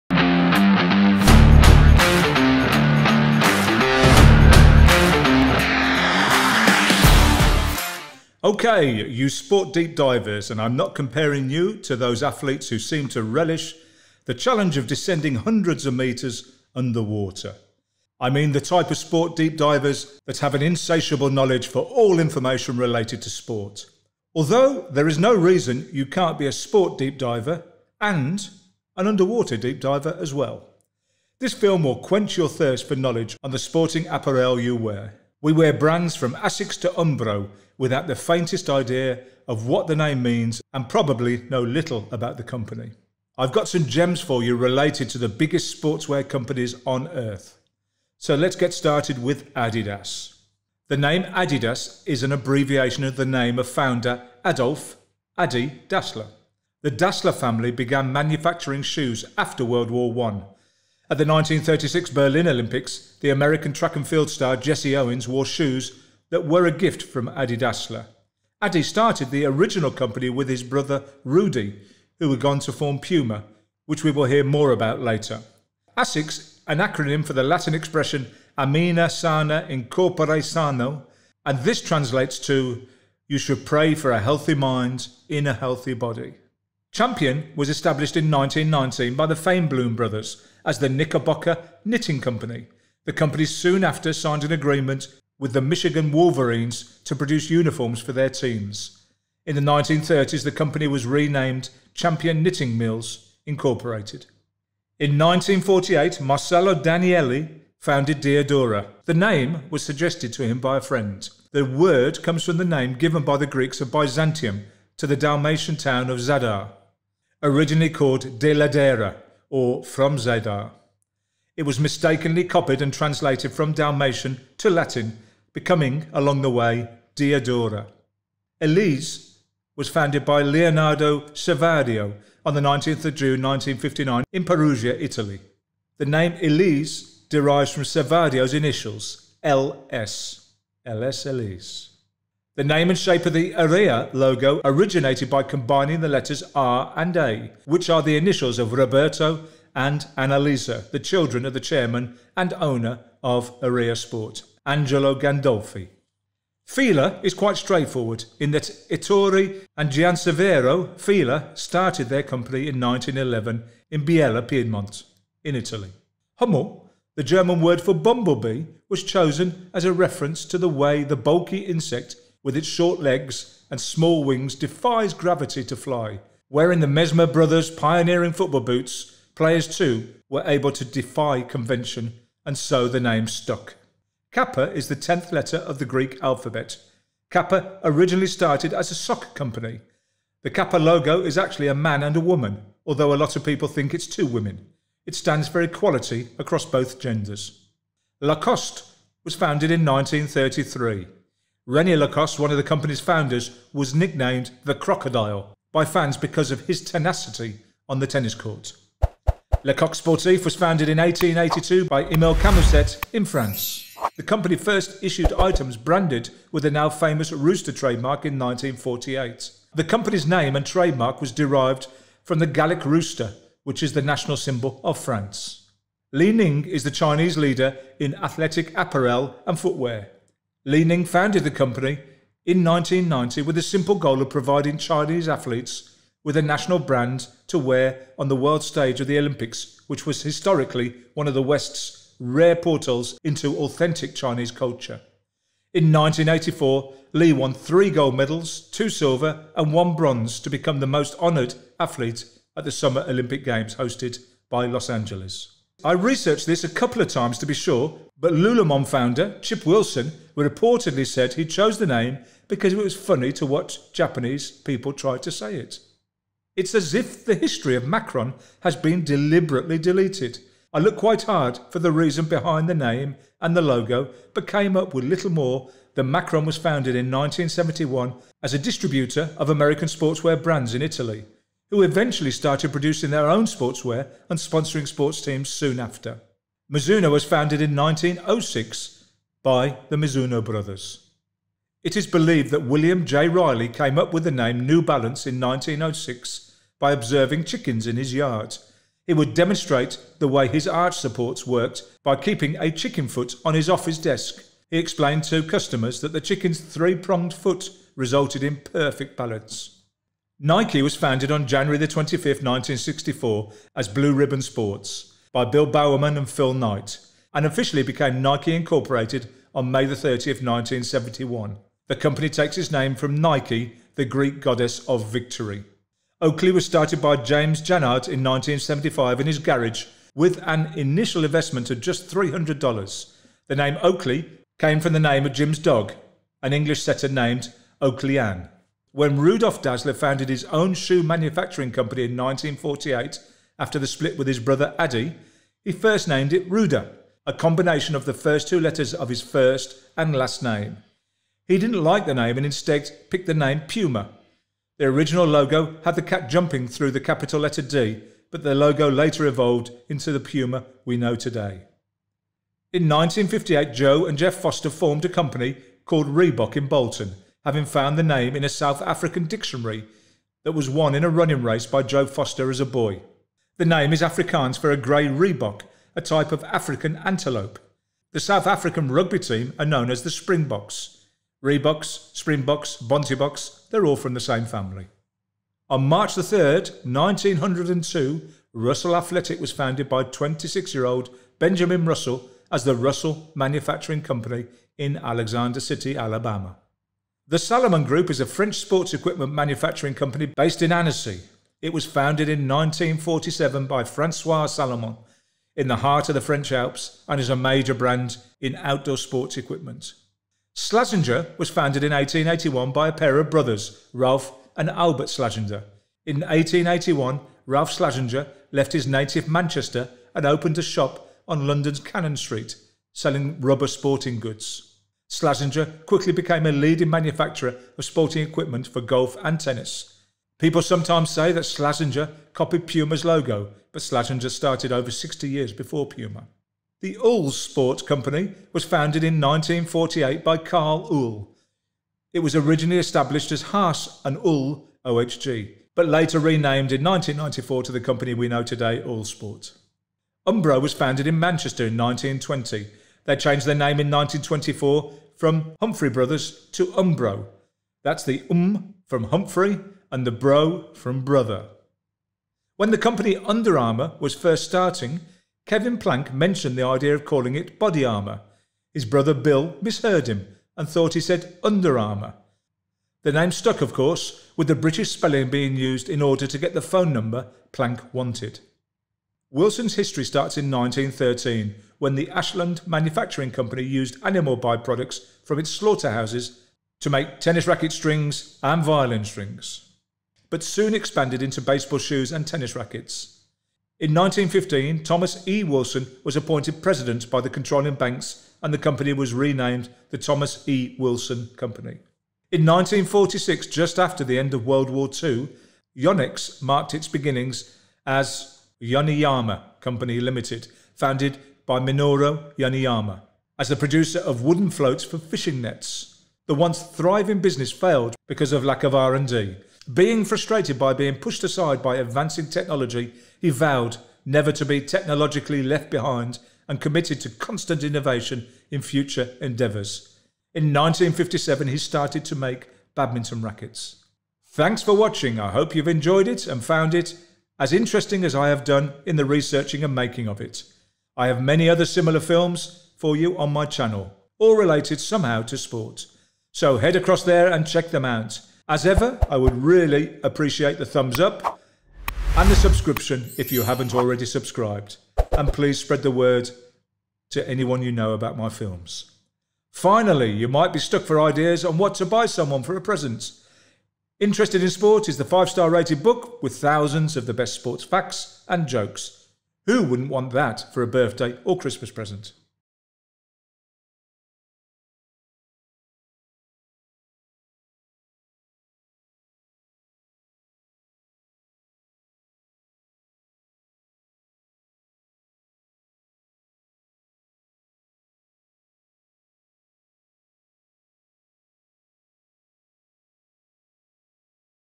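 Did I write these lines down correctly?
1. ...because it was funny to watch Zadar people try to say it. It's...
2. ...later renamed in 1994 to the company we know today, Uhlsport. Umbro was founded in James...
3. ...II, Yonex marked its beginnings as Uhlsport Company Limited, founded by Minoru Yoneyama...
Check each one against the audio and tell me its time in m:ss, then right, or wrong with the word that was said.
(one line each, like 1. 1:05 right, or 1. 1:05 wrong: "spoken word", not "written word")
1. 4:22 wrong: "Japanese", not "Zadar"
2. 7:25 wrong: "Manchester", not "James"
3. 8:25 wrong: "Yoneyama", not "Uhlsport".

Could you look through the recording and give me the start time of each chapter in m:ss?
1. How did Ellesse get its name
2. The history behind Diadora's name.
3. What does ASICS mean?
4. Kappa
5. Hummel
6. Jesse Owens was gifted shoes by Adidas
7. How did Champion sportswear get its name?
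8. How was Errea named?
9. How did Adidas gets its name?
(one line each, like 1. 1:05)
1. 2:07
2. 1:44
3. 1:15
4. 3:03
5. 2:47
6. 1:04
7. 1:26
8. 2:22
9. 0:49.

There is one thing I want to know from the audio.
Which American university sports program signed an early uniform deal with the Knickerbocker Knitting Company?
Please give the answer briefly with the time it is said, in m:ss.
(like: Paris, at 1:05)
Michigan Wolverines, at 1:35.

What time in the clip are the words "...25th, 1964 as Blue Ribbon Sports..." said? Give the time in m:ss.
5:11.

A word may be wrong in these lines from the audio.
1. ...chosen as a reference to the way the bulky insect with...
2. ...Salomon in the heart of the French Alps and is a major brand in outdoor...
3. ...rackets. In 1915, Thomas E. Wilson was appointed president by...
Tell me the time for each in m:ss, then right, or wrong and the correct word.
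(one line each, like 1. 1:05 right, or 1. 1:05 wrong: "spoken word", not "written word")
1. 2:49 right
2. 6:44 right
3. 8:12 right.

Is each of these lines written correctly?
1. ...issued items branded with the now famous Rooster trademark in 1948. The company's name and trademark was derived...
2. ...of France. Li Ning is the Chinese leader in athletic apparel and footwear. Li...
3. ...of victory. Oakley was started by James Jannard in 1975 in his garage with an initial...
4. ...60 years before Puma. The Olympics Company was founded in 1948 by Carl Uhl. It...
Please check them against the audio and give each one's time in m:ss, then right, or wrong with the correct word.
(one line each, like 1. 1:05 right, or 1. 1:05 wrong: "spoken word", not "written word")
1. 3:35 right
2. 3:44 right
3. 5:24 right
4. 7:14 wrong: "Uhlsport", not "Olympics".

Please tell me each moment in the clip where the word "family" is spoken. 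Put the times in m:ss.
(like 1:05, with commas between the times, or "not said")
0:57, 6:24.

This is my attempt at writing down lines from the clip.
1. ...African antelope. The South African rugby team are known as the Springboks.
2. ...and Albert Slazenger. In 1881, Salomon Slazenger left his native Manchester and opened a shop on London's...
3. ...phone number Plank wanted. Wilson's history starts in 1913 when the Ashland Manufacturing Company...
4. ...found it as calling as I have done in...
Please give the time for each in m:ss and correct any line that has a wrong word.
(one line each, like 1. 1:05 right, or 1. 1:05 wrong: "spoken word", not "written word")
1. 6:16 right
2. 6:54 wrong: "Ralph", not "Salomon"
3. 7:56 right
4. 8:56 wrong: "interesting", not "calling".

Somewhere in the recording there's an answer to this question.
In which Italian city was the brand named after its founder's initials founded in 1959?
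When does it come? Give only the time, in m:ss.
2:14.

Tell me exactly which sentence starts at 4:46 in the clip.
Mizuno was founded in 1906 by the Mizuno brothers.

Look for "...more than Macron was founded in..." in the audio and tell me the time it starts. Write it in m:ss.
4:35.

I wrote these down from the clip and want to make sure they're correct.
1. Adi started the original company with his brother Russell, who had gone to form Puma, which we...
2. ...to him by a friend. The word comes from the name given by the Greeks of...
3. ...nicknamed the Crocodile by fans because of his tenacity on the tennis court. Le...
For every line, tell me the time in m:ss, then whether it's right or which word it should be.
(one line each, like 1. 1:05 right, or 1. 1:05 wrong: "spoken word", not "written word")
1. 1:08 wrong: "Rudy", not "Russell"
2. 1:50 right
3. 3:23 right.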